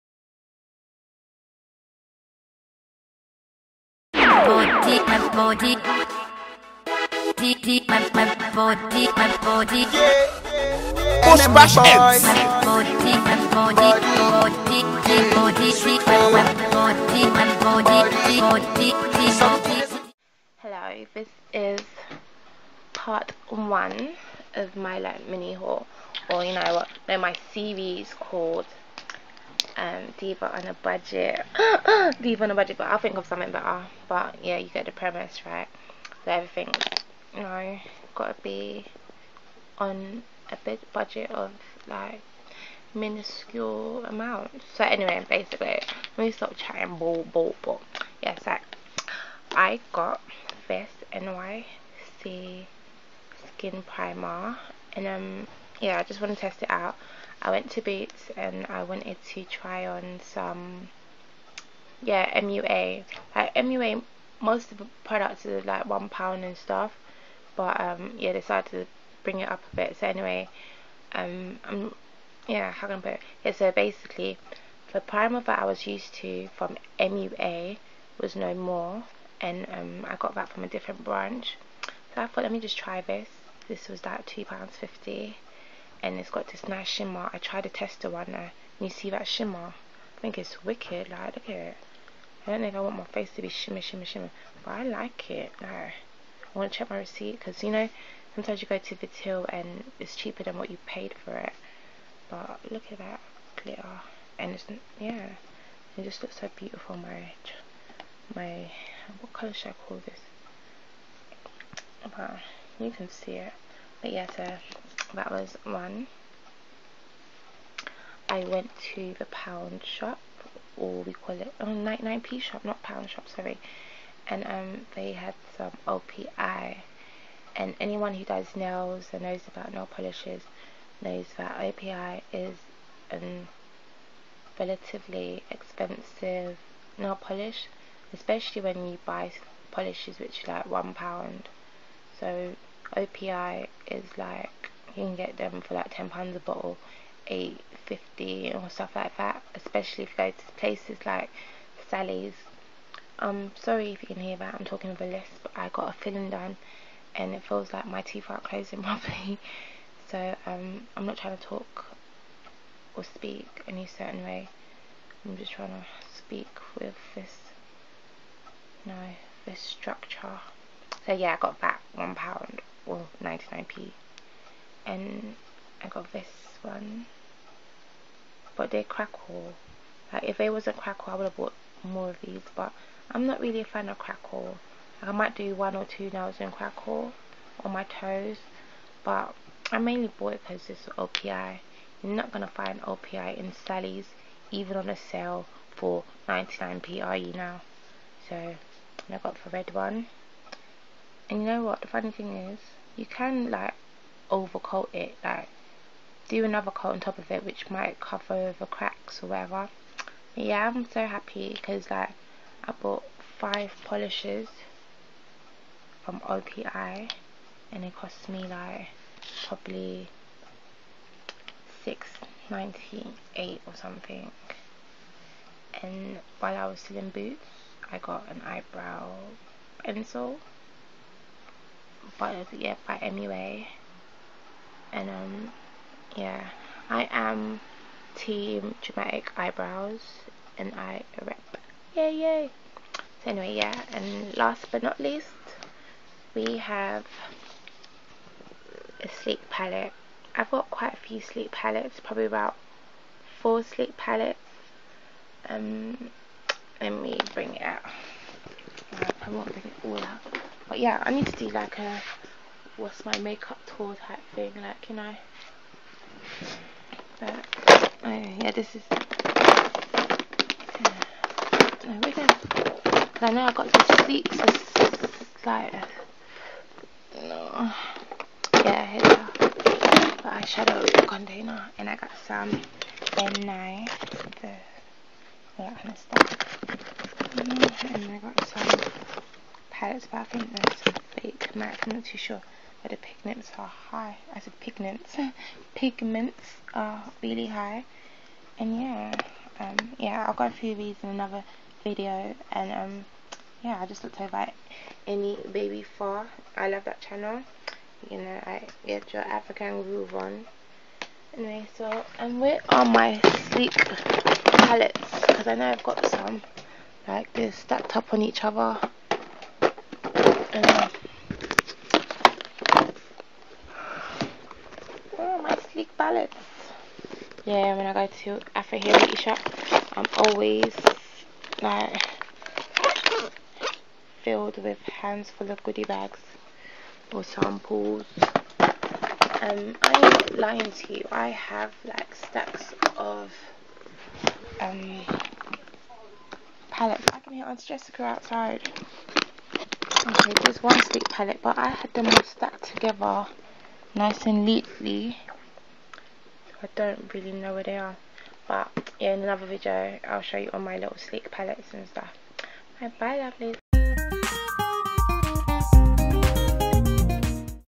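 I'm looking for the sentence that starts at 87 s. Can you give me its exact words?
I tried to test the one now, uh, and you see that shimmer?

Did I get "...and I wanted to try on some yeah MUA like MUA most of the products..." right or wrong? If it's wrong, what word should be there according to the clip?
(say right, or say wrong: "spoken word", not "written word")
right.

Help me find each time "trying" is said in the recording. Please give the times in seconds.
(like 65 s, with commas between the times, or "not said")
161 s, 165 s.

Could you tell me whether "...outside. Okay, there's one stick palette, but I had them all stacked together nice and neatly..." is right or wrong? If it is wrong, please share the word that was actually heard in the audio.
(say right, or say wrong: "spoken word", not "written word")
right.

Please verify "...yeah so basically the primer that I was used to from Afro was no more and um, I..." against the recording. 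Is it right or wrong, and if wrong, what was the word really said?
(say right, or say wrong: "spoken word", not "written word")
wrong: "MUA", not "Afro".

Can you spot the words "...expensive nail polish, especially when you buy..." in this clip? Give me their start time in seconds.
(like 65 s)
135 s.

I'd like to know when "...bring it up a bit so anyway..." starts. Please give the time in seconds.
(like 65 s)
69 s.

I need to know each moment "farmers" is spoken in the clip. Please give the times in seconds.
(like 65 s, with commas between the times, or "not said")
not said.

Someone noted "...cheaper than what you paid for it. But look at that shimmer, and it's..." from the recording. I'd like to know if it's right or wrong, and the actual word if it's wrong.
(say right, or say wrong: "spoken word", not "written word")
wrong: "glitter", not "shimmer".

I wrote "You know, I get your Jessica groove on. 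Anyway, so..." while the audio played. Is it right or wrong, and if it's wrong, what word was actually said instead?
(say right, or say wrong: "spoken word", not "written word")
wrong: "African", not "Jessica".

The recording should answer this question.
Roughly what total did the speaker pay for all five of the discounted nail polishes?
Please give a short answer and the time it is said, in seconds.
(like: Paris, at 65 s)
6.98, at 221 s.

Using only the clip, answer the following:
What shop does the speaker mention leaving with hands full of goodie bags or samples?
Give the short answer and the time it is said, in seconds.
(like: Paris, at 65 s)
Afro Hair Beauty Shop, at 328 s.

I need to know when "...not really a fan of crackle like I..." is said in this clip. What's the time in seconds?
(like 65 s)
183 s.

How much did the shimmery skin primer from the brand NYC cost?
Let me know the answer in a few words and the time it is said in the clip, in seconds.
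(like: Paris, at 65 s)
£2.50, at 84 s.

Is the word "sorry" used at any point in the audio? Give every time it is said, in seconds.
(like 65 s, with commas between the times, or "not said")
123 s, 153 s.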